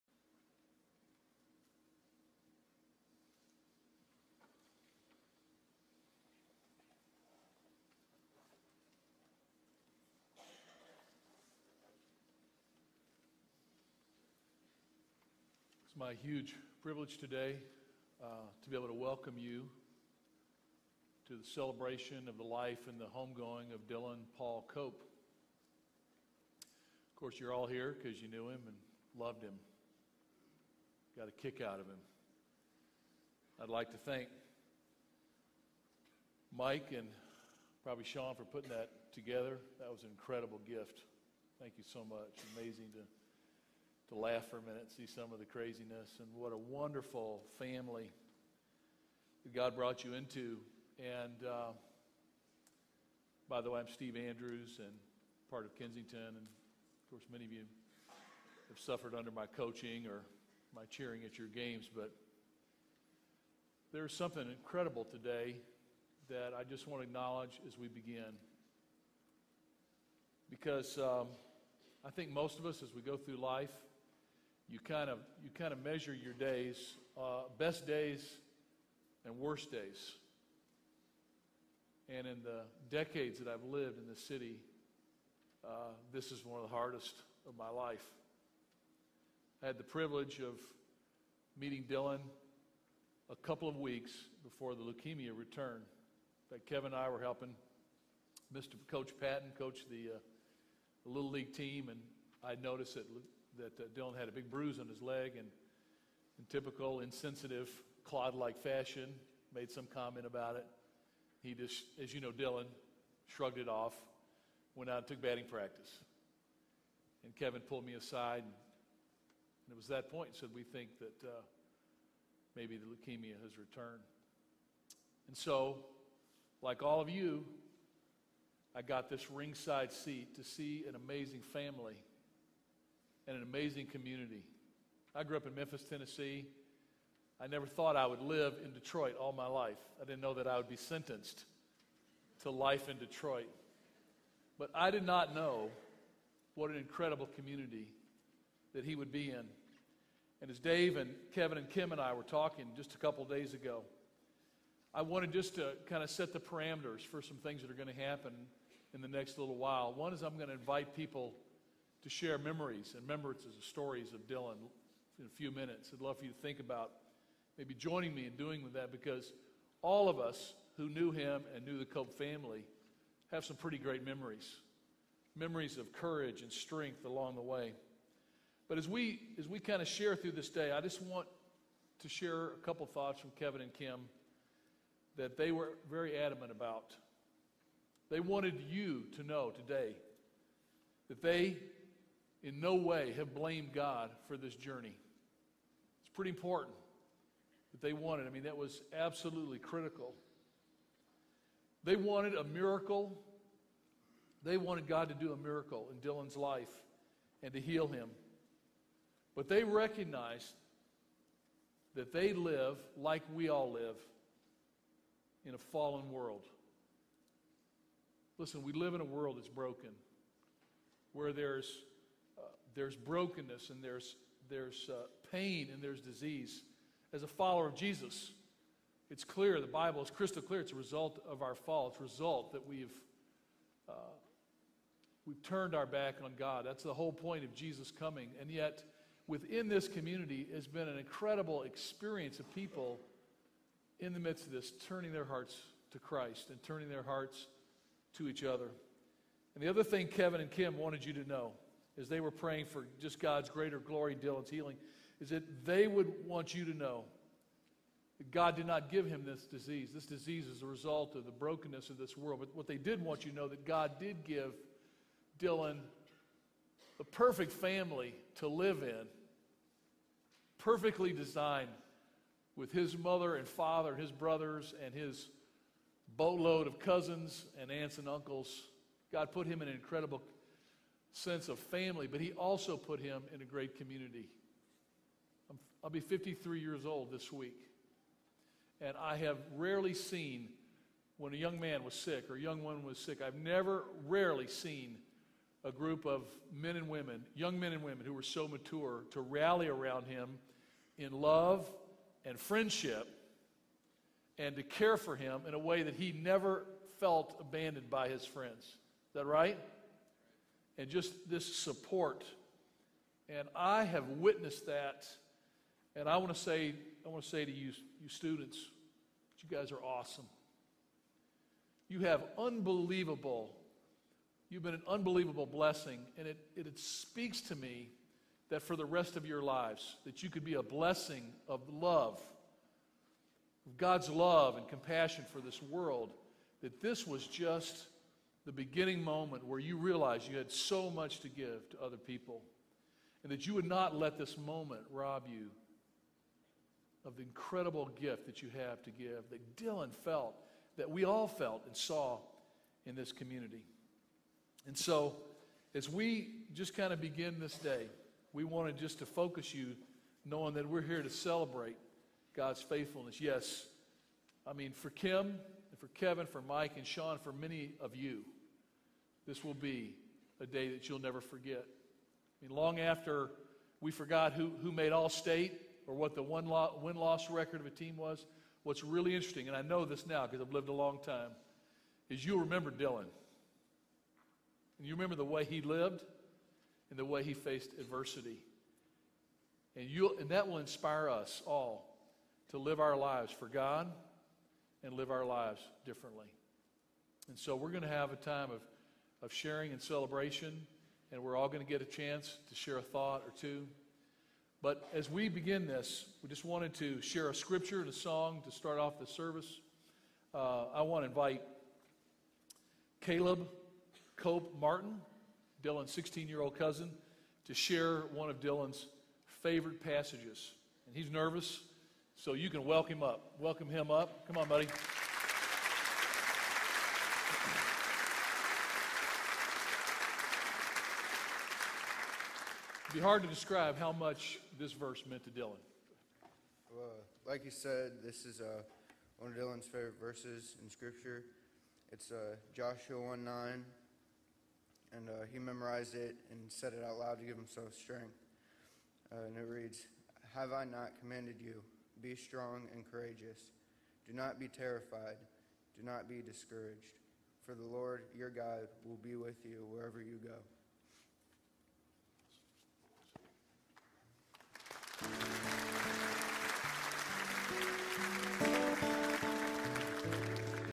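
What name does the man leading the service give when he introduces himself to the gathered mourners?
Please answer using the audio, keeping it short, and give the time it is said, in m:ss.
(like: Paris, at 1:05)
Steve Andrews, at 0:53.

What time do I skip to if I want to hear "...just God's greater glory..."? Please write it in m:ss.
4:12.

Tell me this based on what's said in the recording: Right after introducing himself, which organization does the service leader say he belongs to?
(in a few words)
Kensington.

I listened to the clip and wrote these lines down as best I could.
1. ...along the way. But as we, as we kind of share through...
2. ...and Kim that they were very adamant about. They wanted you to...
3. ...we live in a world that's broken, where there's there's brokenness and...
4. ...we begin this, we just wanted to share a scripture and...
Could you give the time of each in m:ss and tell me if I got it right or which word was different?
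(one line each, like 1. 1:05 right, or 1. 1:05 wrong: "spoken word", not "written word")
1. 2:57 right
2. 3:03 right
3. 3:38 right
4. 6:45 right.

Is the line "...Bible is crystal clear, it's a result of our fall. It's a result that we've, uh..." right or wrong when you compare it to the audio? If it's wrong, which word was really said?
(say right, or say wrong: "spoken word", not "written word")
right.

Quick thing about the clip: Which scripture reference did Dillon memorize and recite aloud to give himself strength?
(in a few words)
Joshua 1:9.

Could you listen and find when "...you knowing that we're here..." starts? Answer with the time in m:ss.
5:59.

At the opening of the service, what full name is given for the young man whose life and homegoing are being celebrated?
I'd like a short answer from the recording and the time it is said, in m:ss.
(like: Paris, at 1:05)
Dillon Paul Cope, at 0:23.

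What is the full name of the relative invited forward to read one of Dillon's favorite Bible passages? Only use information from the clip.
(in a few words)
Caleb Cope Martin.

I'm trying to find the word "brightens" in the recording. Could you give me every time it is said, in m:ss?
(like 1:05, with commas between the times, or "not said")
not said.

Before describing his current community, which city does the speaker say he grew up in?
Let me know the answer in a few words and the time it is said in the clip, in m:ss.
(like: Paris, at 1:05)
Memphis, Tennessee, at 2:15.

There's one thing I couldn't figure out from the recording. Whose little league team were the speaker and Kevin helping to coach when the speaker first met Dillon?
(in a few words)
Coach Patton.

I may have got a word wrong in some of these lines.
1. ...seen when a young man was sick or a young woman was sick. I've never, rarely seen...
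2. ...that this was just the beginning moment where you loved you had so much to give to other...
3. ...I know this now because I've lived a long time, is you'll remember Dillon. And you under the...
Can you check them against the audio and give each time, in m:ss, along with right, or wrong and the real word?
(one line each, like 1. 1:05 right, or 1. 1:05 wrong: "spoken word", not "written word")
1. 4:49 right
2. 5:36 wrong: "realized", not "loved"
3. 6:19 wrong: "remember", not "under".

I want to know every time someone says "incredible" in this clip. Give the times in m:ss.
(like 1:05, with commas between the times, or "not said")
0:40, 1:04, 2:26, 4:00, 4:39, 5:47.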